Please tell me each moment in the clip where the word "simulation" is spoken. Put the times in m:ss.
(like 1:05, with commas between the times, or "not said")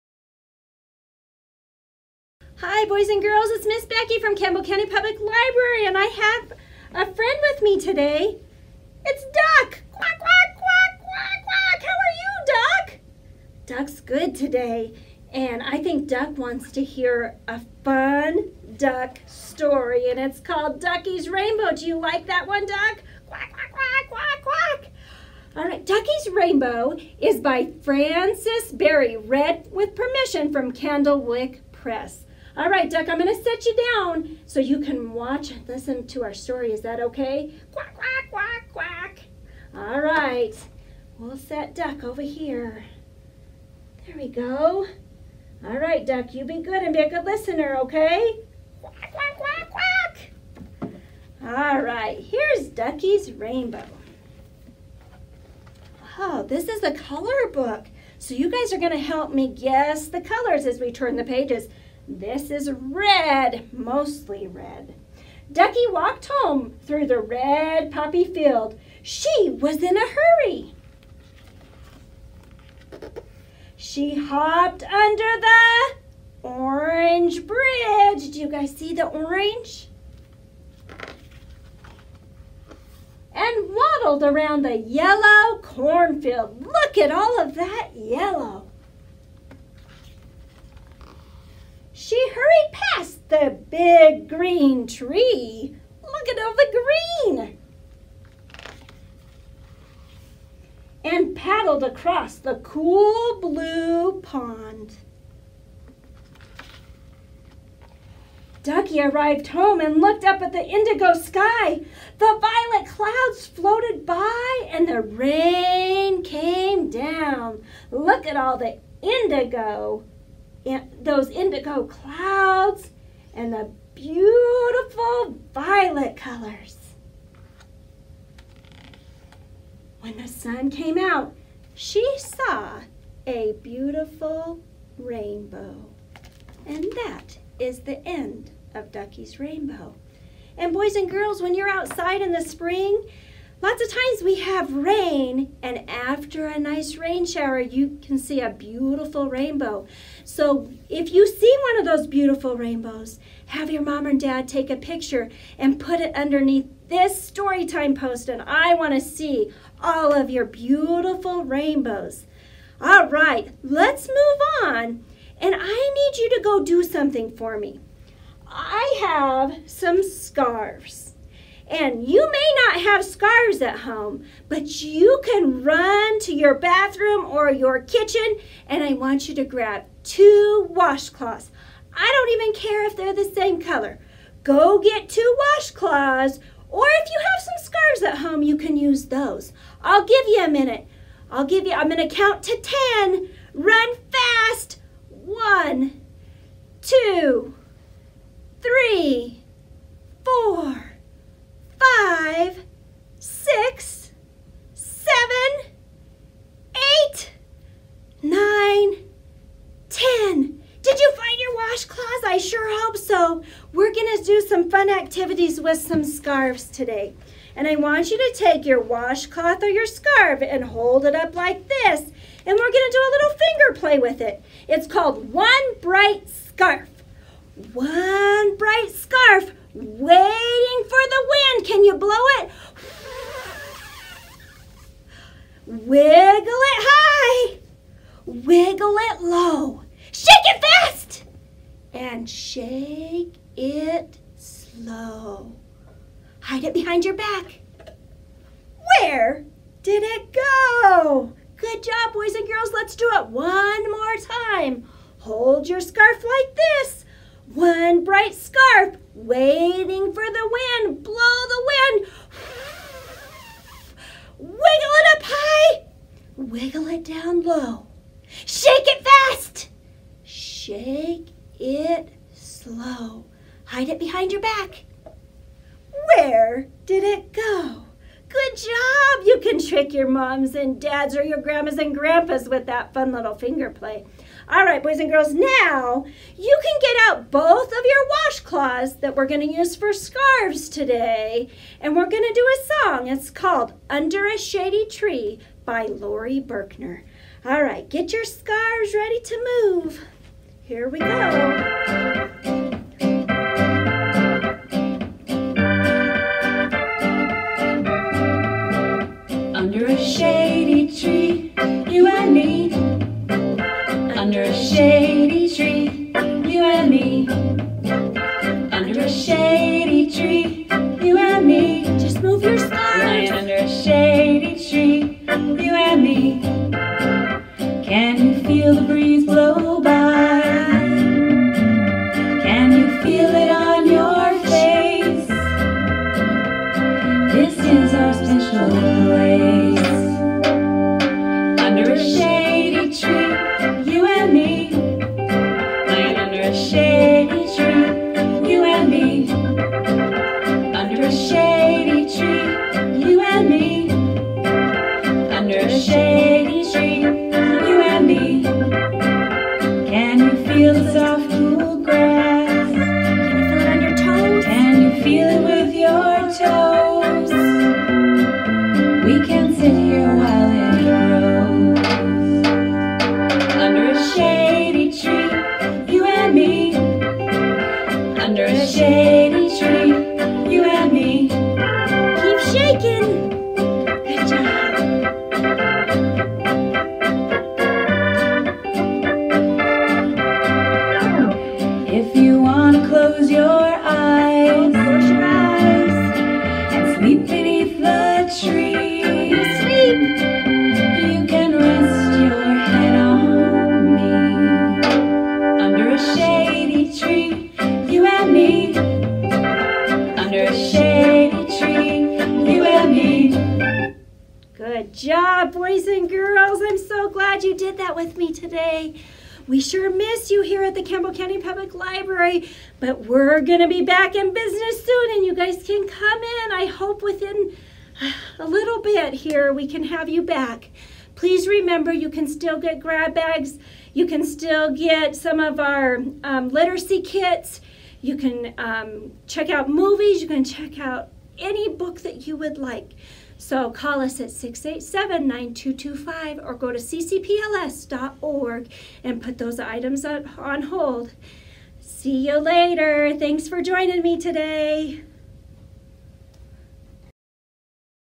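not said.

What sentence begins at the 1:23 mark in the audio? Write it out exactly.
And waddled around the yellow cornfield.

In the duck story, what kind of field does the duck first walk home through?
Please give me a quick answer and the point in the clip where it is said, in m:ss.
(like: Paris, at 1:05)
red poppy field, at 1:07.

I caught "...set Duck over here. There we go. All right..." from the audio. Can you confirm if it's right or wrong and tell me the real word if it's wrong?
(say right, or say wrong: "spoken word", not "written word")
right.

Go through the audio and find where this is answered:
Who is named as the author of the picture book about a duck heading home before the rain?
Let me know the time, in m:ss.
0:27.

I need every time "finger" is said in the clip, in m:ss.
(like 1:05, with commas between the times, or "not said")
3:43, 4:43.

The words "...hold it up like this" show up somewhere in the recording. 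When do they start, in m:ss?
3:40.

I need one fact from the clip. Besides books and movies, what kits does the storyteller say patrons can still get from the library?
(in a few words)
literacy kits.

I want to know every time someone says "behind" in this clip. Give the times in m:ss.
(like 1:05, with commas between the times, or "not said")
4:06, 4:33.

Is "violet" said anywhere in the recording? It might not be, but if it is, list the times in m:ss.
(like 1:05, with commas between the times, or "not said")
1:52, 2:05.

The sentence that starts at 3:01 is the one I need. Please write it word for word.
I don't even care if they're the same color.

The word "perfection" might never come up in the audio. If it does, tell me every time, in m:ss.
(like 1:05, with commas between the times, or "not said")
not said.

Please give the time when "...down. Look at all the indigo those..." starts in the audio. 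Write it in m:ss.
1:56.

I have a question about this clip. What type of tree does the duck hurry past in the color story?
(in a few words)
big green tree.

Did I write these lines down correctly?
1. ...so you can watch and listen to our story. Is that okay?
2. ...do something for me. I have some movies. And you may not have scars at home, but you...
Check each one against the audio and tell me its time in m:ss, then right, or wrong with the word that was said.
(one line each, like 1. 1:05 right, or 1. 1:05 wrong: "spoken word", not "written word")
1. 0:34 right
2. 2:46 wrong: "scarves", not "movies".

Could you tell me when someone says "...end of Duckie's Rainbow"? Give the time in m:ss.
2:18.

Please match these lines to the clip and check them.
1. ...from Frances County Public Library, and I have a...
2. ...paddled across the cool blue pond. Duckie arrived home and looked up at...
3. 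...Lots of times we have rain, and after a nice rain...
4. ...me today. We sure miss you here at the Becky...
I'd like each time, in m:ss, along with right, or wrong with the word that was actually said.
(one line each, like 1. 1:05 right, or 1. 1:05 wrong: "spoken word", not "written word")
1. 0:04 wrong: "Campbell", not "Frances"
2. 1:41 right
3. 2:23 right
4. 6:58 wrong: "Campbell", not "Becky".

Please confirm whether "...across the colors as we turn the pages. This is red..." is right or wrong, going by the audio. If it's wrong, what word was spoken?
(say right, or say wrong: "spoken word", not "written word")
wrong: "guess", not "across".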